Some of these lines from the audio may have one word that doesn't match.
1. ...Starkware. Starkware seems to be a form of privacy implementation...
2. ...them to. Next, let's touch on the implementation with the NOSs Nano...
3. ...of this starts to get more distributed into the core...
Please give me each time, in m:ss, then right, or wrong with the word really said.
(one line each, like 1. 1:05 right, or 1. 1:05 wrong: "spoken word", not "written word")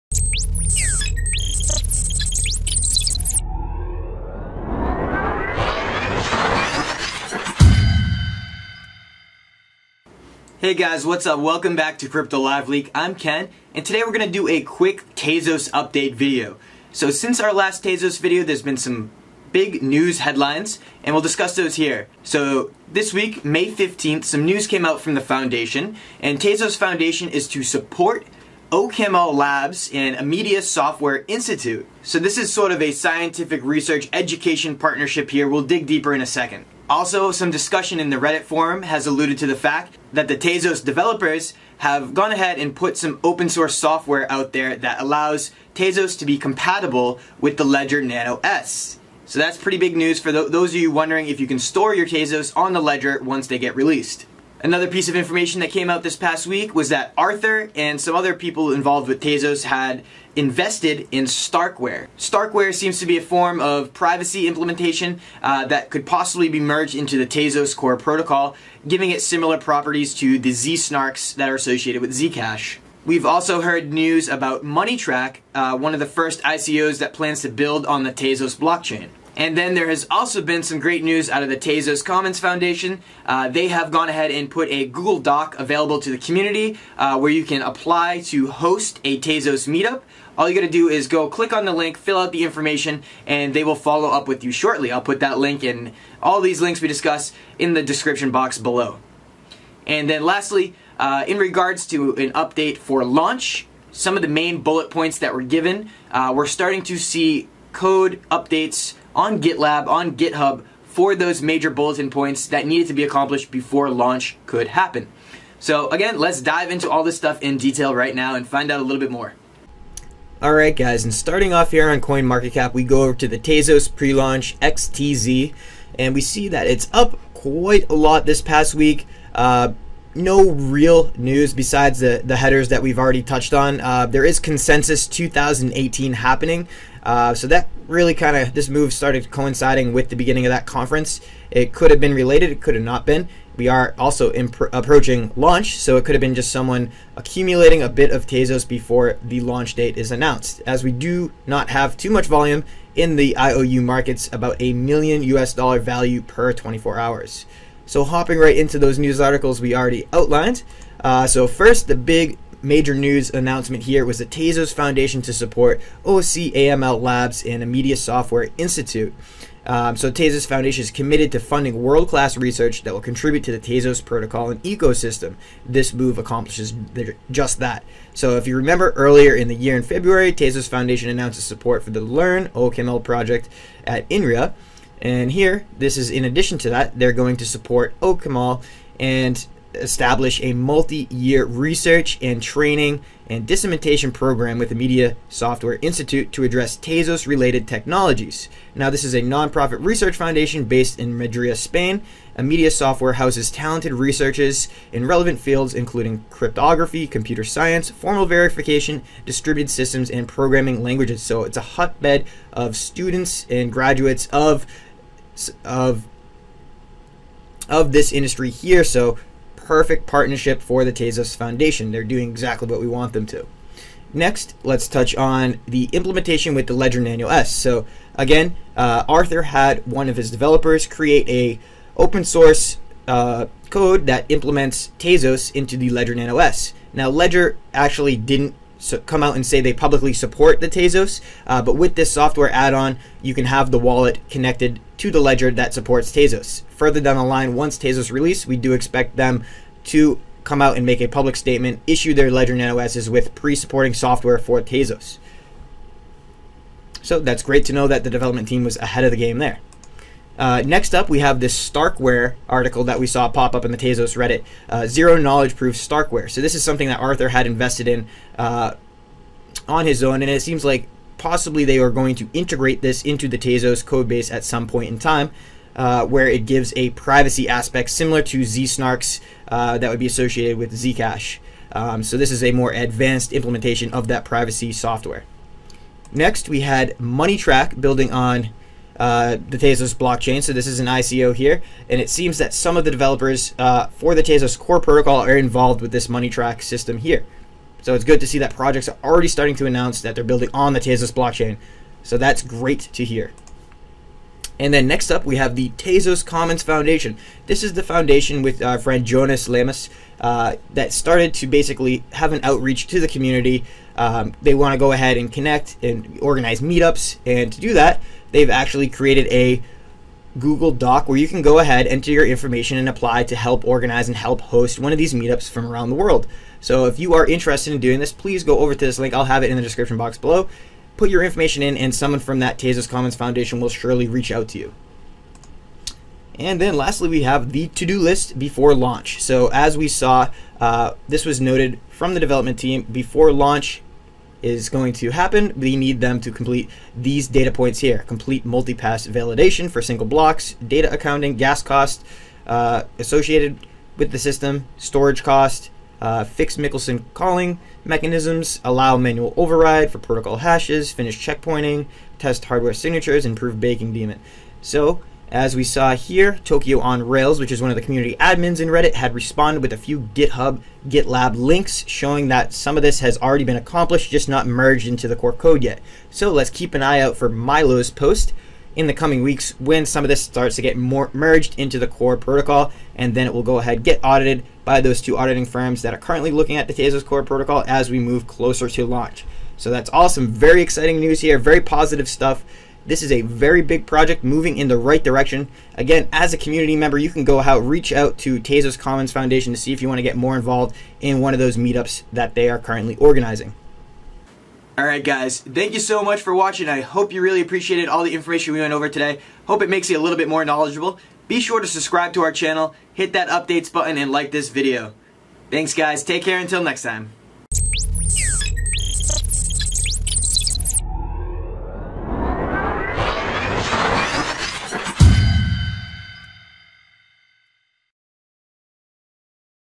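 1. 1:01 right
2. 3:43 wrong: "Ledger", not "NOSs"
3. 6:20 wrong: "merged", not "distributed".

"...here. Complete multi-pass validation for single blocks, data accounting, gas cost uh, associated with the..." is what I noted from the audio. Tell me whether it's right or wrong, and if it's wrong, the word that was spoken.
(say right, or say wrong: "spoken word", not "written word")
right.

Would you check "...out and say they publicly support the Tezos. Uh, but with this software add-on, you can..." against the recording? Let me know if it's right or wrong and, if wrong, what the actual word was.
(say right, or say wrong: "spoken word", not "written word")
right.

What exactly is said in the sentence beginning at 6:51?
Be sure to subscribe to our channel, hit that updates button, and like this video.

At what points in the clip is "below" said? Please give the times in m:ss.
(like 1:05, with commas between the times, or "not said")
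1:38, 5:30.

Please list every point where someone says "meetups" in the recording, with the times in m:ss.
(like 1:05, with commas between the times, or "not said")
1:29, 5:16, 5:25, 6:41.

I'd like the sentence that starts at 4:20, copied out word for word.
Uh, next up, we have this Starkware article that we saw pop up in the Tezos Reddit, uh, Zero Knowledge Proof Starkware.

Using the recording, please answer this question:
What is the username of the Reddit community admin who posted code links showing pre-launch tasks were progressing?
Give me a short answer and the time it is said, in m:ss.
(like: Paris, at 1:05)
Tokyo on Rails, at 6:06.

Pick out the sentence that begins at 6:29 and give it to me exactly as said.
So that's awesome, very exciting news here, very positive stuff.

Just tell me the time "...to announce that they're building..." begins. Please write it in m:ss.
4:59.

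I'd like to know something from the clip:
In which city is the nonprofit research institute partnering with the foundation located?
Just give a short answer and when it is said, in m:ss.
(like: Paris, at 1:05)
Madrid, at 3:21.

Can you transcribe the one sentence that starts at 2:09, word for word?
Uh, no real news besides the, the headers that we've already touched on.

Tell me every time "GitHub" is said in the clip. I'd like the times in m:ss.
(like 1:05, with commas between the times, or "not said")
1:50, 6:10.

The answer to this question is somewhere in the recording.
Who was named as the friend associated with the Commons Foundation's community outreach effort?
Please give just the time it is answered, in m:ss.
5:09.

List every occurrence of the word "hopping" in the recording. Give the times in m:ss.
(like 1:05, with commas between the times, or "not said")
2:38.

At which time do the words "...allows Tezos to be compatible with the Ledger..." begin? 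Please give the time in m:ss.
0:45.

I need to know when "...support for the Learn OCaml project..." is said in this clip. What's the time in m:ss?
3:01.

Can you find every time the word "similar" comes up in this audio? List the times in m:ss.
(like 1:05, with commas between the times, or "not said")
1:09, 4:37.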